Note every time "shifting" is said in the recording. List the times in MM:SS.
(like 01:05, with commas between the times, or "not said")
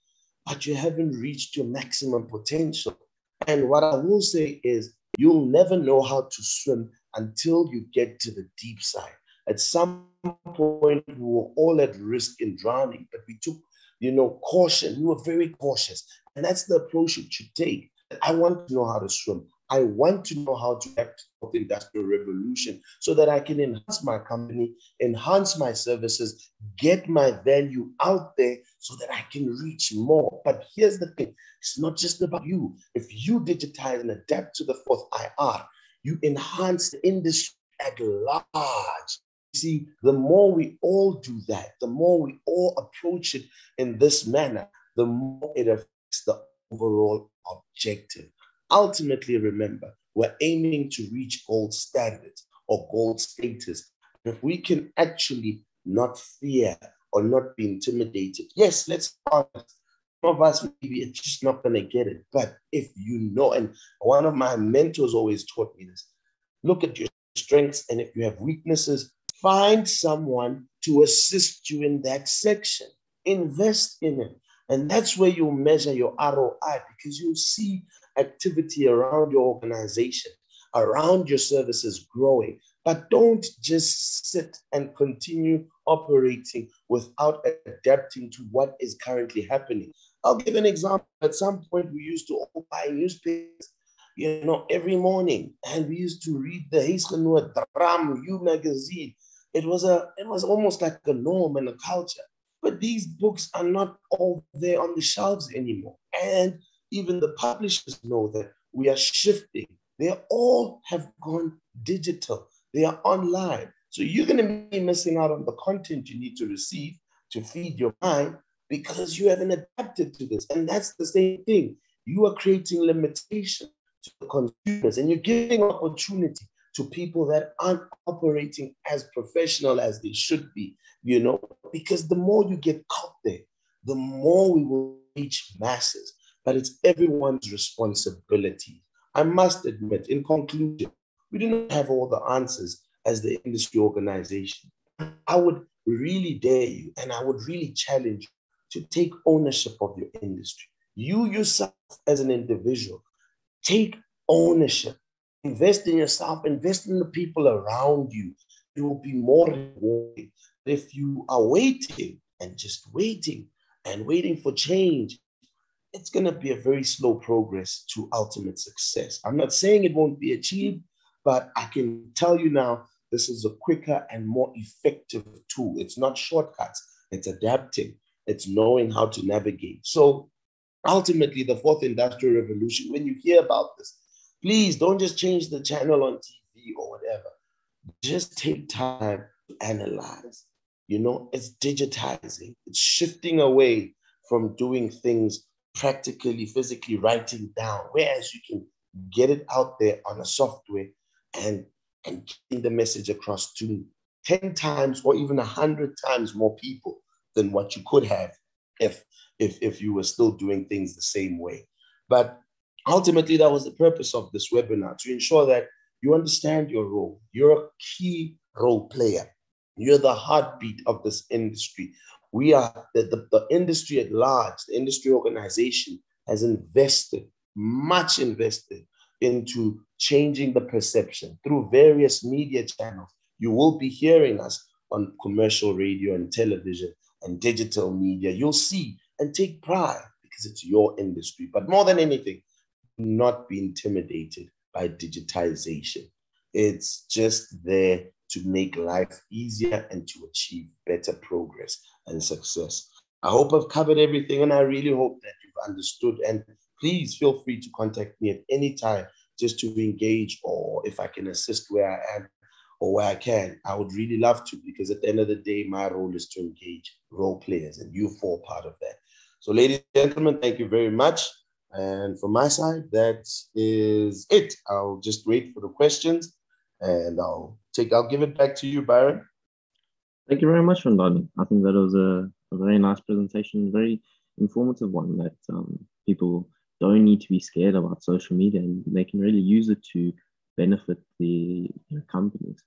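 01:48, 03:12.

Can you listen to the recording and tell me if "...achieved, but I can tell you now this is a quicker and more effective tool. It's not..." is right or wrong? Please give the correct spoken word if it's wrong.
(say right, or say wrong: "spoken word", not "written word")
right.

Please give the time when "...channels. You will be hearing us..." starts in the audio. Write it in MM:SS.
03:52.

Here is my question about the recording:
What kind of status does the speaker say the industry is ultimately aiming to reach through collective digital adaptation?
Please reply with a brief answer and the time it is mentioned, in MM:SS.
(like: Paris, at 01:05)
gold status, at 00:52.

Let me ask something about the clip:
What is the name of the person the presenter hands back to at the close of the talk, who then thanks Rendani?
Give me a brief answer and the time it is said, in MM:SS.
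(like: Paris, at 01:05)
Byron, at 04:38.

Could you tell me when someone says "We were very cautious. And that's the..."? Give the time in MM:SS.
00:14.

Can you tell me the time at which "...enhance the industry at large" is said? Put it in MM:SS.
00:36.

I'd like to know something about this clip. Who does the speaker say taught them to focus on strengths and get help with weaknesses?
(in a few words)
one of my mentors.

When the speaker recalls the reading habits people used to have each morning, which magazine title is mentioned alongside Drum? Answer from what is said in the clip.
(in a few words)
Huisgenoot.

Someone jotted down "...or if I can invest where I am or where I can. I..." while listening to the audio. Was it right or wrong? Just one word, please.
wrong.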